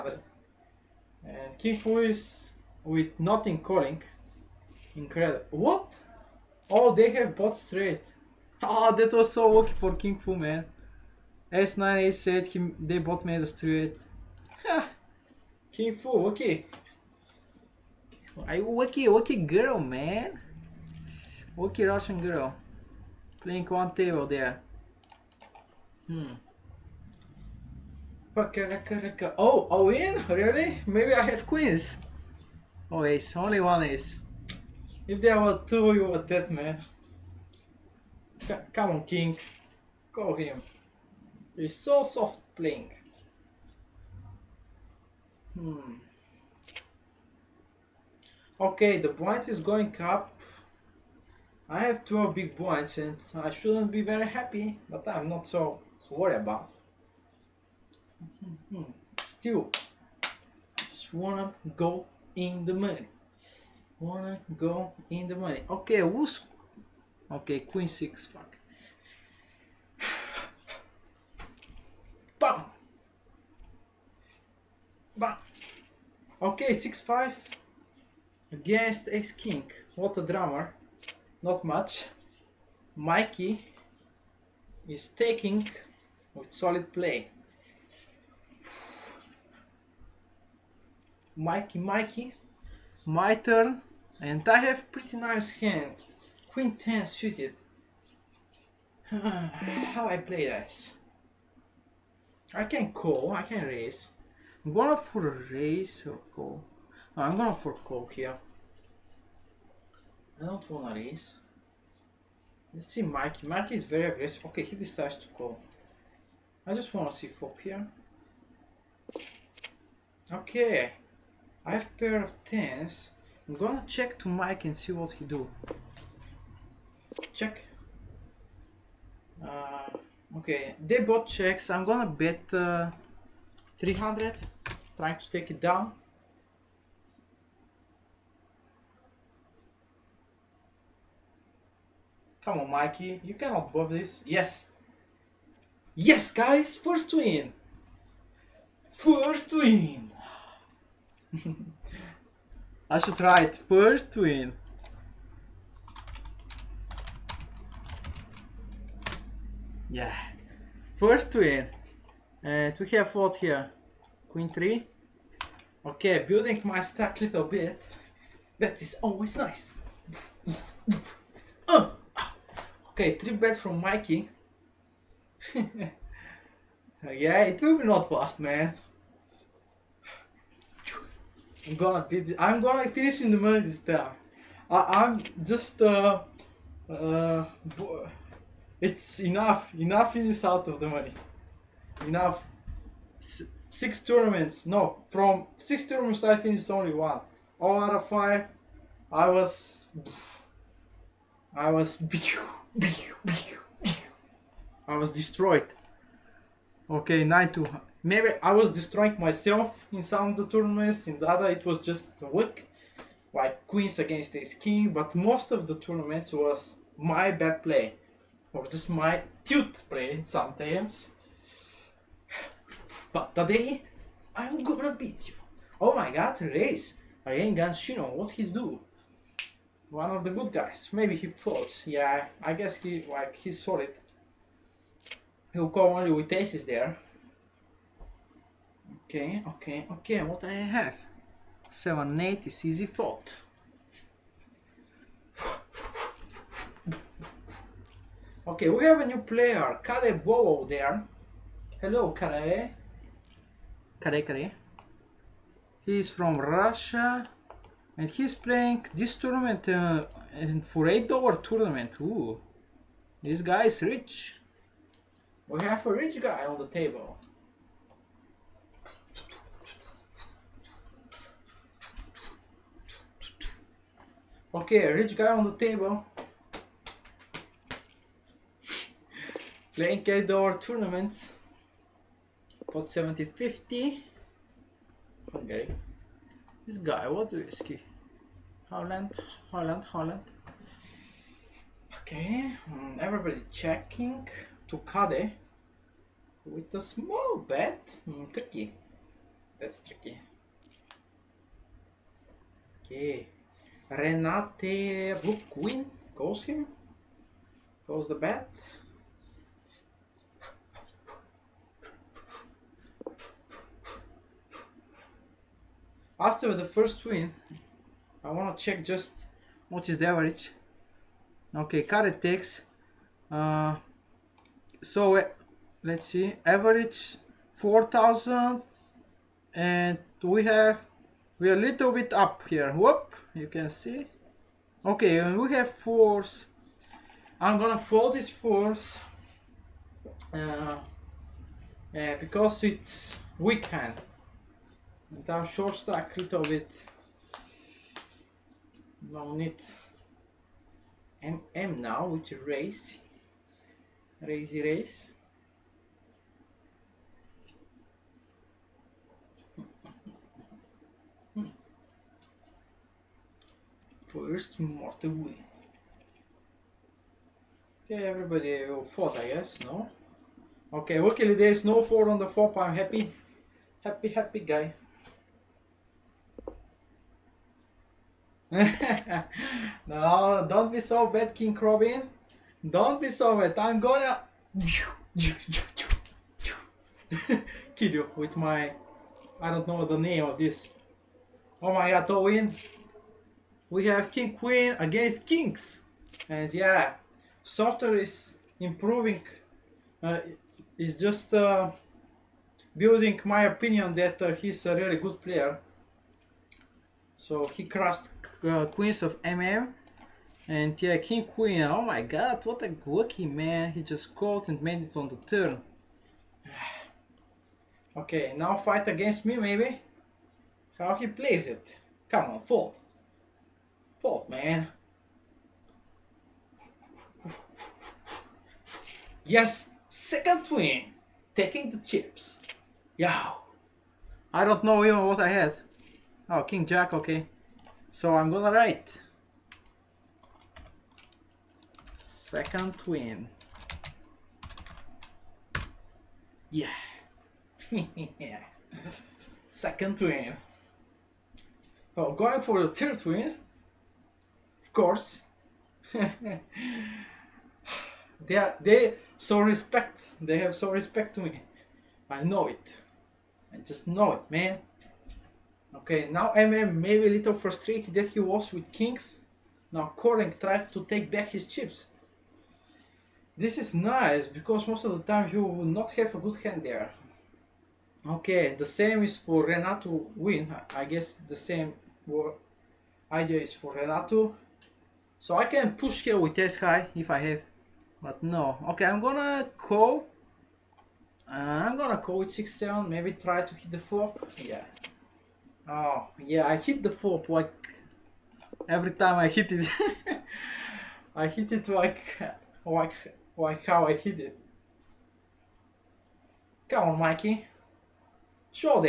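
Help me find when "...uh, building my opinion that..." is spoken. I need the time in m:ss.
6:41.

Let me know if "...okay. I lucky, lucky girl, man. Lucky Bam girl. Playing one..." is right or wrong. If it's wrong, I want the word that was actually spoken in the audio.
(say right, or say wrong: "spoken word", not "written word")
wrong: "Russian", not "Bam".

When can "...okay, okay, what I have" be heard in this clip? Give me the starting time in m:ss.
3:59.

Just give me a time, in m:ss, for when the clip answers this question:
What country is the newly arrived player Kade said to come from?
4:16.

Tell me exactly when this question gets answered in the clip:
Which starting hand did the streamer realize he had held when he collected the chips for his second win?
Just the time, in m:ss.
7:16.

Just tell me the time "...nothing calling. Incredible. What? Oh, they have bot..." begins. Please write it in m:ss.
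0:03.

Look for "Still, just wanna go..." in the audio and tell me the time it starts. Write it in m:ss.
0:59.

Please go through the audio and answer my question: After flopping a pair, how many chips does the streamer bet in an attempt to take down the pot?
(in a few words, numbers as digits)
300.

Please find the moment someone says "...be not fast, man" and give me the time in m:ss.
2:57.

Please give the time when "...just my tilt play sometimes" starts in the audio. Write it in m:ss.
3:38.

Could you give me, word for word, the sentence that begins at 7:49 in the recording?
Now Koring tried to take back his chips.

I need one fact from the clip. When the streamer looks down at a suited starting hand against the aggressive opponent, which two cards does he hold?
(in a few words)
Queen 10 suited.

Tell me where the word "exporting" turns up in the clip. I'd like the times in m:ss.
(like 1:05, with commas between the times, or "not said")
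not said.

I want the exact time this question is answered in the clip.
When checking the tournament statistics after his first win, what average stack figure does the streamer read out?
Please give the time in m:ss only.
5:27.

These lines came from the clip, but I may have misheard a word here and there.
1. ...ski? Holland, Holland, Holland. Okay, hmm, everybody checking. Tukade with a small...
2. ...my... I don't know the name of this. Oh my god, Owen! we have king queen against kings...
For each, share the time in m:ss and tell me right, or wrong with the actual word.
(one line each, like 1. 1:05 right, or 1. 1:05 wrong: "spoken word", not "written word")
1. 4:47 right
2. 6:28 right.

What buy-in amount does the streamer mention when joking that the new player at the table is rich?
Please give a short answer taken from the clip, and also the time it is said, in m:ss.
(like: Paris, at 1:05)
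$8, at 4:20.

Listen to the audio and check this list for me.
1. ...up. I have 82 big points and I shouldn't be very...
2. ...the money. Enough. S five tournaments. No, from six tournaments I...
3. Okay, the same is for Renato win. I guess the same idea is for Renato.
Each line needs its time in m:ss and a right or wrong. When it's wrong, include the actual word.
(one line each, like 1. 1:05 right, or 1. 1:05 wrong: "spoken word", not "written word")
1. 0:50 wrong: "12", not "82"
2. 3:10 wrong: "six", not "five"
3. 7:58 right.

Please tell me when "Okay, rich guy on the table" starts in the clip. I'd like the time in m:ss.
4:34.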